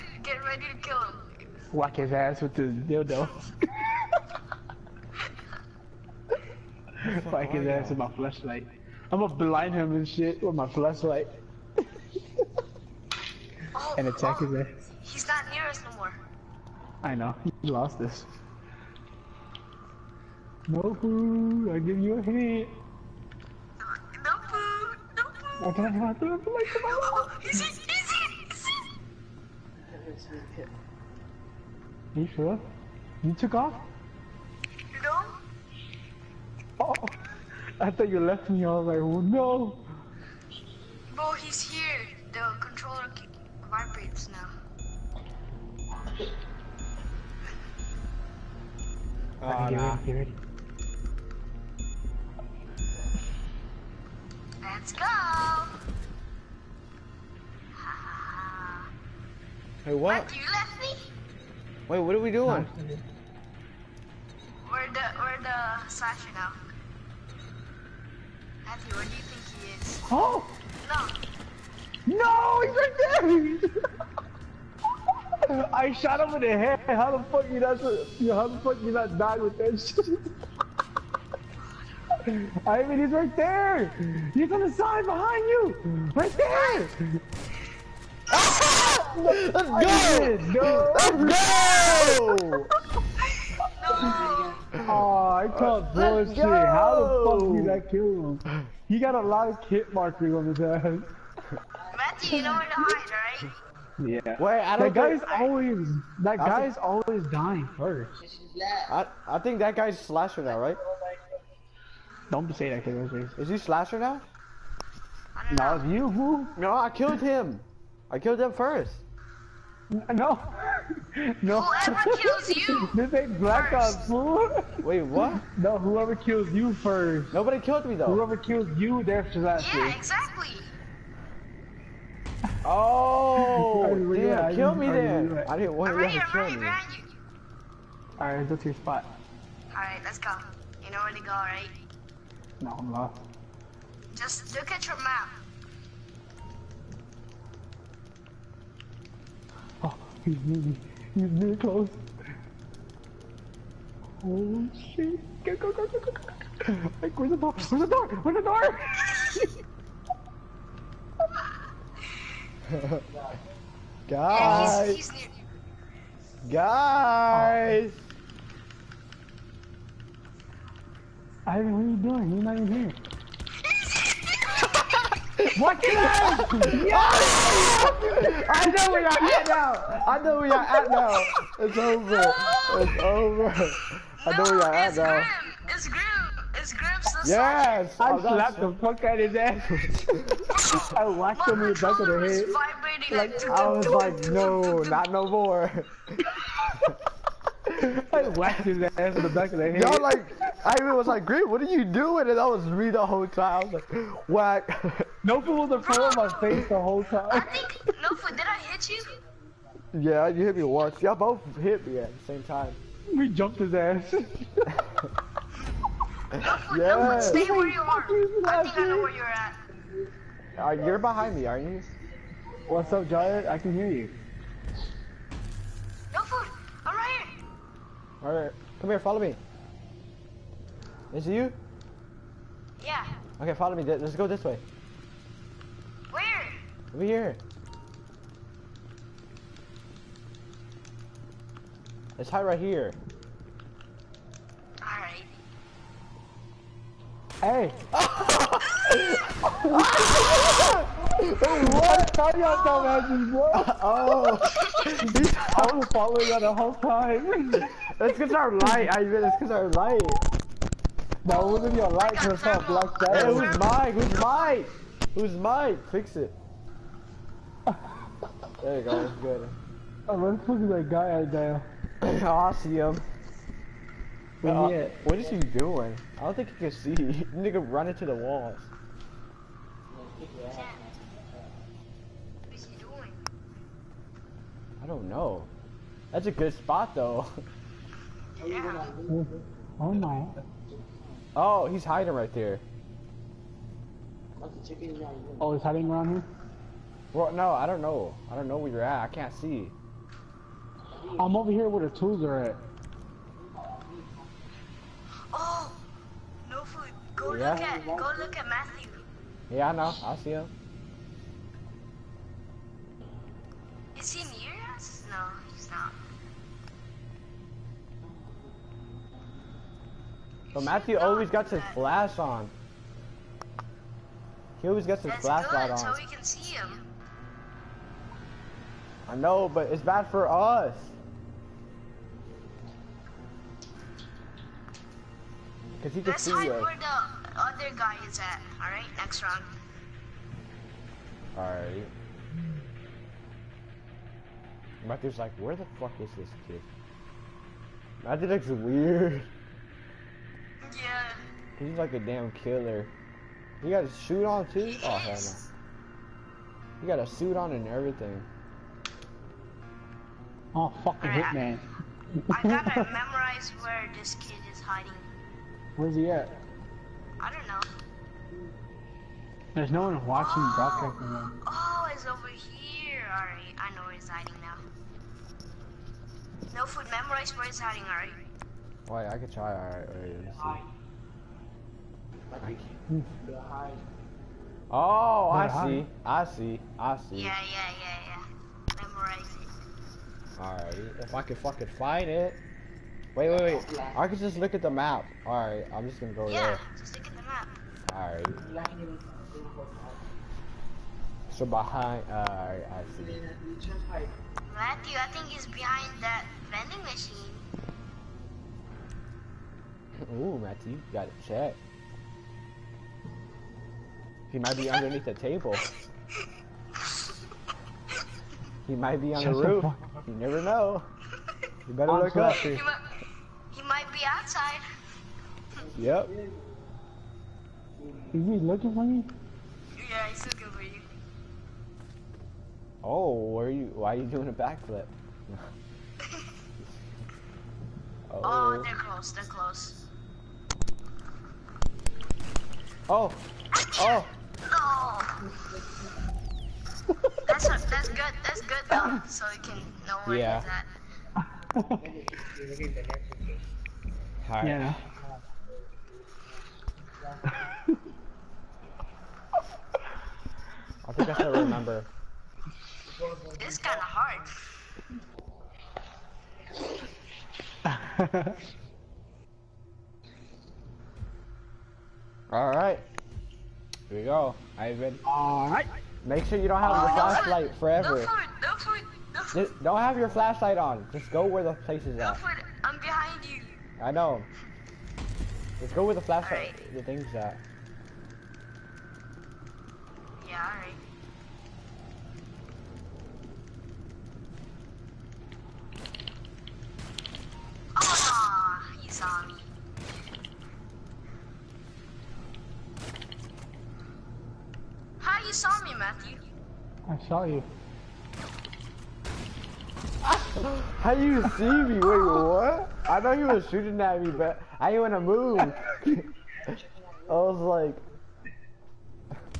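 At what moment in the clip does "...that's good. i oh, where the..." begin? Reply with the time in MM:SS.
04:29.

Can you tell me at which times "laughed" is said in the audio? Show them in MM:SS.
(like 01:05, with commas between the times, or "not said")
03:18.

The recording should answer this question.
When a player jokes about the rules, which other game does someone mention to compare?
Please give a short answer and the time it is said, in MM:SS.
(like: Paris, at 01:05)
Black Ops, at 02:02.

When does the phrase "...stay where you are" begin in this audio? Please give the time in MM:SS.
03:37.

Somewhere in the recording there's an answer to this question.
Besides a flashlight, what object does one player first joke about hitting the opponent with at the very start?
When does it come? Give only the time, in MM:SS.
00:02.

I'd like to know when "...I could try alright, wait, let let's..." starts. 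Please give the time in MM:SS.
06:19.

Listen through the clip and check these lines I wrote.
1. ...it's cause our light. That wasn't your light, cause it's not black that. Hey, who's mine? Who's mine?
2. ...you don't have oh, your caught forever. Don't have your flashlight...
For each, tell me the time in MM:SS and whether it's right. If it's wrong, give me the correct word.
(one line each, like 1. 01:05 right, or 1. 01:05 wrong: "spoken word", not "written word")
1. 04:19 right
2. 07:56 wrong: "flashlight", not "caught".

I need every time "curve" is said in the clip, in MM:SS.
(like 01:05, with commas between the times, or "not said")
not said.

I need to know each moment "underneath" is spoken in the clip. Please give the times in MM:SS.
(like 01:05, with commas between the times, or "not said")
06:54.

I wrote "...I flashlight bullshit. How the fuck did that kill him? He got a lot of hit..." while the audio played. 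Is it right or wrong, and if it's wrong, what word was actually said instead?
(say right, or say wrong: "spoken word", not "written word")
wrong: "caught", not "flashlight".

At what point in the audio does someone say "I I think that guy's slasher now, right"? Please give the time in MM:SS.
01:48.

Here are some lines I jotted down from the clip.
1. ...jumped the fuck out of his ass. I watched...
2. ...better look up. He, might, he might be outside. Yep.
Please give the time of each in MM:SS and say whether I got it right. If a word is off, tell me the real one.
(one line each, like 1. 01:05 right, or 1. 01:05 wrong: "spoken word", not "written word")
1. 03:08 wrong: "slapped", not "jumped"
2. 07:01 right.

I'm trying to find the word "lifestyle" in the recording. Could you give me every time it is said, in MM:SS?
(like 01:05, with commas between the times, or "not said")
not said.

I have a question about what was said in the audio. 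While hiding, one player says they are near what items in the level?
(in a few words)
the tools.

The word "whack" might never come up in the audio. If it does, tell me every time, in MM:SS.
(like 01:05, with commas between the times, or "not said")
00:01, 00:07, 03:24.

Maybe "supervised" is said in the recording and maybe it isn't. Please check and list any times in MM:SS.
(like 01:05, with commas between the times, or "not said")
not said.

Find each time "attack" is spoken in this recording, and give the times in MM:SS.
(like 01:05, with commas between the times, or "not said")
00:14.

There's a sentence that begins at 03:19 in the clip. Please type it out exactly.
Y'all like, I even was like, Green, what are you doing?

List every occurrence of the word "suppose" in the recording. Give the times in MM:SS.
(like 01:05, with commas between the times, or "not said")
not said.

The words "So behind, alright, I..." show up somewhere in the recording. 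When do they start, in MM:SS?
06:41.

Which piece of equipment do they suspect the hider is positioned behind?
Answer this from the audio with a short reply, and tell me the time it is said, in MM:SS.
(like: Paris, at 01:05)
vending machine, at 06:46.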